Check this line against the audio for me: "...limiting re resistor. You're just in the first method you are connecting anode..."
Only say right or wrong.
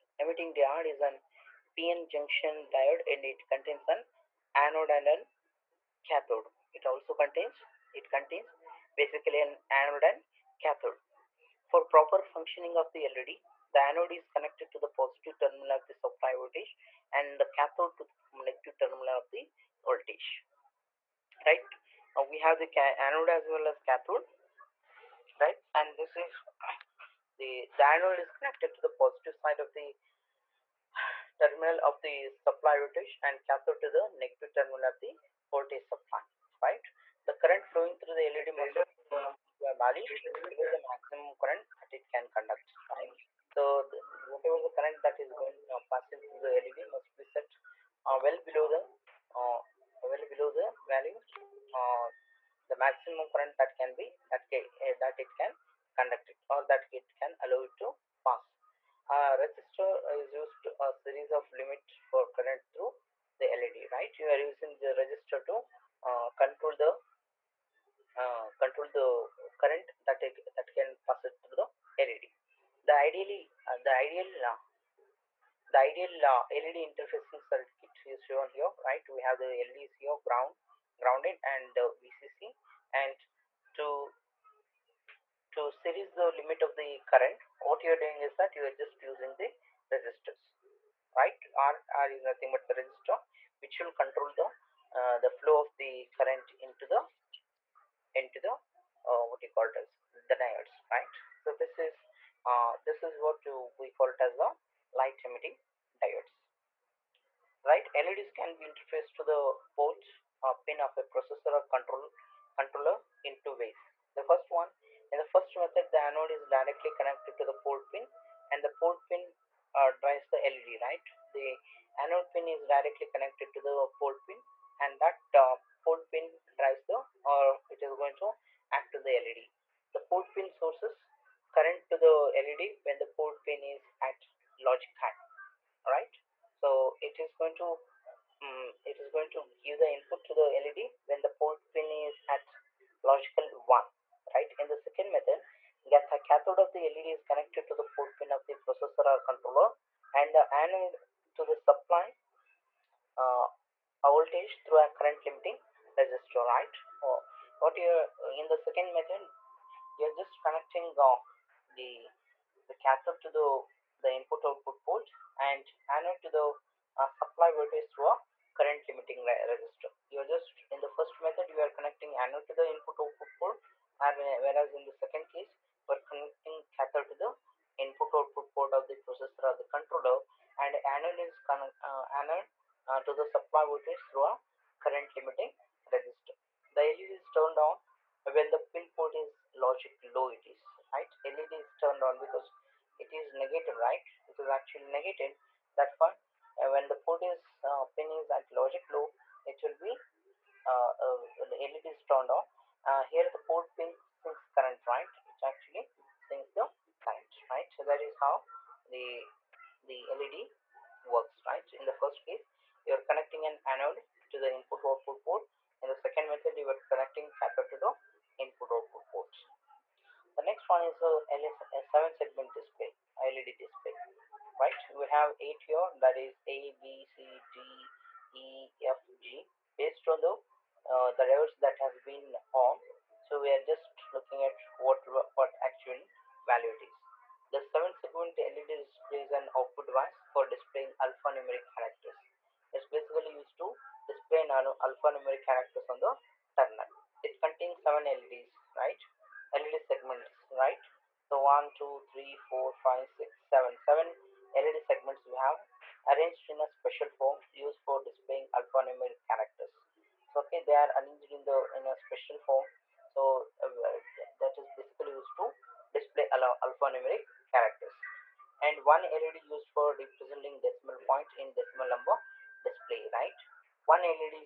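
right.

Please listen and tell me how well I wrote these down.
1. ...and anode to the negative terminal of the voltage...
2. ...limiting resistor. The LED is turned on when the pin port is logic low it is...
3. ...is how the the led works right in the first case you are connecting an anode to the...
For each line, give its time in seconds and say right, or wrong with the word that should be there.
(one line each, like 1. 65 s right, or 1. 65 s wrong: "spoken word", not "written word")
1. 33 s wrong: "cathode", not "anode"
2. 185 s right
3. 208 s right.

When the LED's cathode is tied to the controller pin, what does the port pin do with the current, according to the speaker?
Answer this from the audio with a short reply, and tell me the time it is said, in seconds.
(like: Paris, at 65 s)
Sinks current, at 204 s.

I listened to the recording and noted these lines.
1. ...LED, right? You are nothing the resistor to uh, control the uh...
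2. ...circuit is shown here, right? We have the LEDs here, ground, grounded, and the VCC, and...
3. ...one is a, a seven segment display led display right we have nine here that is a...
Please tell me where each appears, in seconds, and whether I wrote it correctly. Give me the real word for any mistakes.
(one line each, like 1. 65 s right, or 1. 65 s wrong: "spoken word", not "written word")
1. 63 s wrong: "using", not "nothing"
2. 77 s right
3. 220 s wrong: "eight", not "nine".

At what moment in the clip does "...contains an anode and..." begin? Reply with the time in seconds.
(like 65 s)
3 s.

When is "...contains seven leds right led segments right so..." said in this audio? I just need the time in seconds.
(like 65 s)
247 s.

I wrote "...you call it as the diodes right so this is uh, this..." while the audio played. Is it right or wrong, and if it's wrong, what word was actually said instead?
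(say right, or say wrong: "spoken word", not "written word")
right.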